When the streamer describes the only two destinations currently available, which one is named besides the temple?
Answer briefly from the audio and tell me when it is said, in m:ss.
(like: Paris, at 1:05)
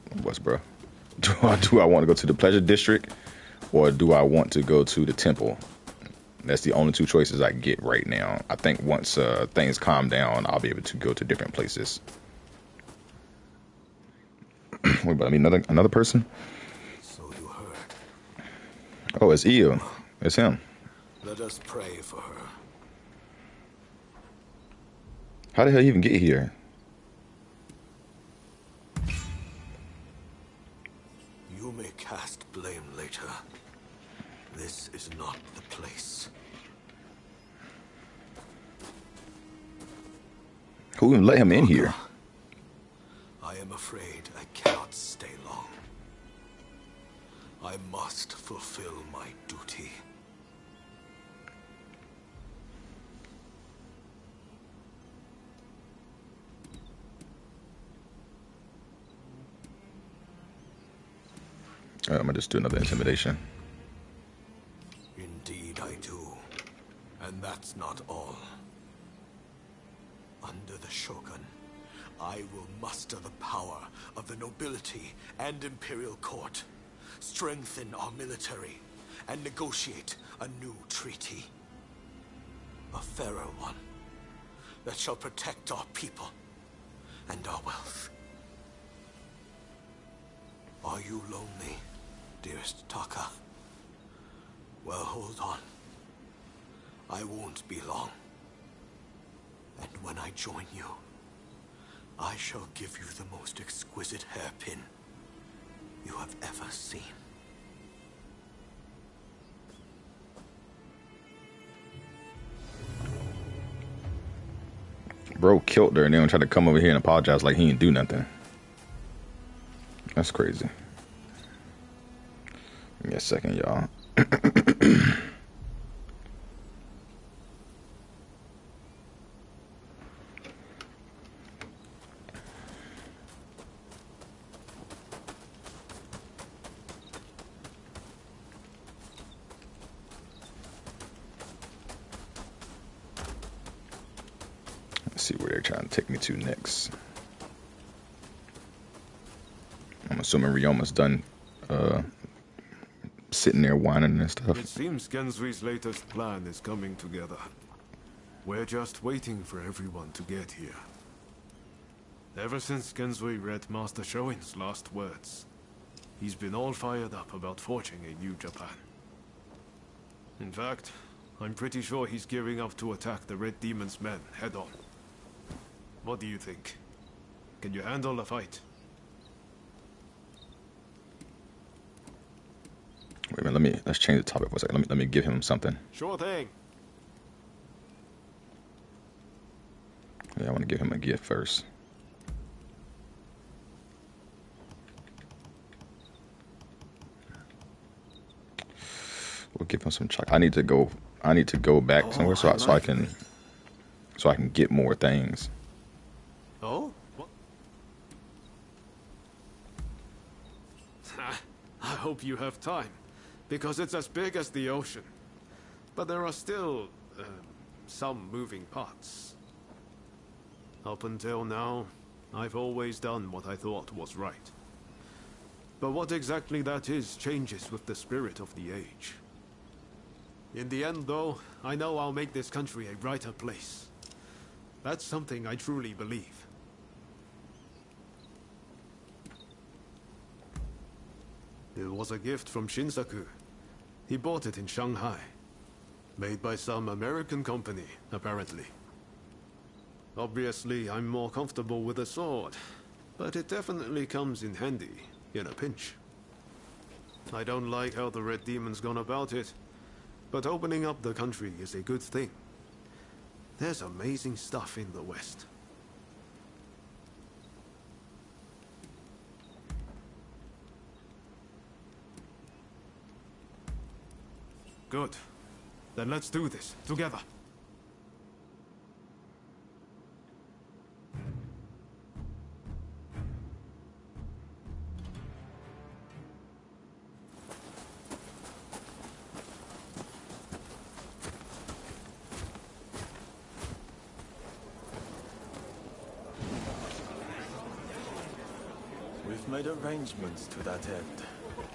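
Pleasure district, at 0:02.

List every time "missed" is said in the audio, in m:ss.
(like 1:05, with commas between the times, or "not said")
not said.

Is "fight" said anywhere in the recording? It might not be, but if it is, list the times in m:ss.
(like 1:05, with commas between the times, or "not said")
2:58.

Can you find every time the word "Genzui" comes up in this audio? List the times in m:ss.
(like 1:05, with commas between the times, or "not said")
2:35, 2:42.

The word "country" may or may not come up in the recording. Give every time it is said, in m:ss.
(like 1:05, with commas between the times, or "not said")
3:52, 4:21.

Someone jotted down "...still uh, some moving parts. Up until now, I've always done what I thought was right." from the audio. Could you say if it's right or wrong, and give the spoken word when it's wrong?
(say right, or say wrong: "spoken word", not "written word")
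right.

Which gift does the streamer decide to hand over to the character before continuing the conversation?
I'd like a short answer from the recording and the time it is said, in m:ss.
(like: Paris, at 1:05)
Chocolate, at 3:20.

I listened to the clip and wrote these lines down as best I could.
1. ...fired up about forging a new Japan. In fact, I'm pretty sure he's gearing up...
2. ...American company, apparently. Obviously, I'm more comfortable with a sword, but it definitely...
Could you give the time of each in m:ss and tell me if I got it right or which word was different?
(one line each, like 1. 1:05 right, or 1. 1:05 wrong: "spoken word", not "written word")
1. 2:46 right
2. 4:06 right.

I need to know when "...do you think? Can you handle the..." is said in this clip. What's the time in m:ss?
2:56.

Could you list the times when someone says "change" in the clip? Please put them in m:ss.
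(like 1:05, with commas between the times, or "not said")
3:03, 3:47.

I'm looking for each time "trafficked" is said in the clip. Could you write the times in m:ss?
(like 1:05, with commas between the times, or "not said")
not said.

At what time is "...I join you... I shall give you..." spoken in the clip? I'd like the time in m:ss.
1:40.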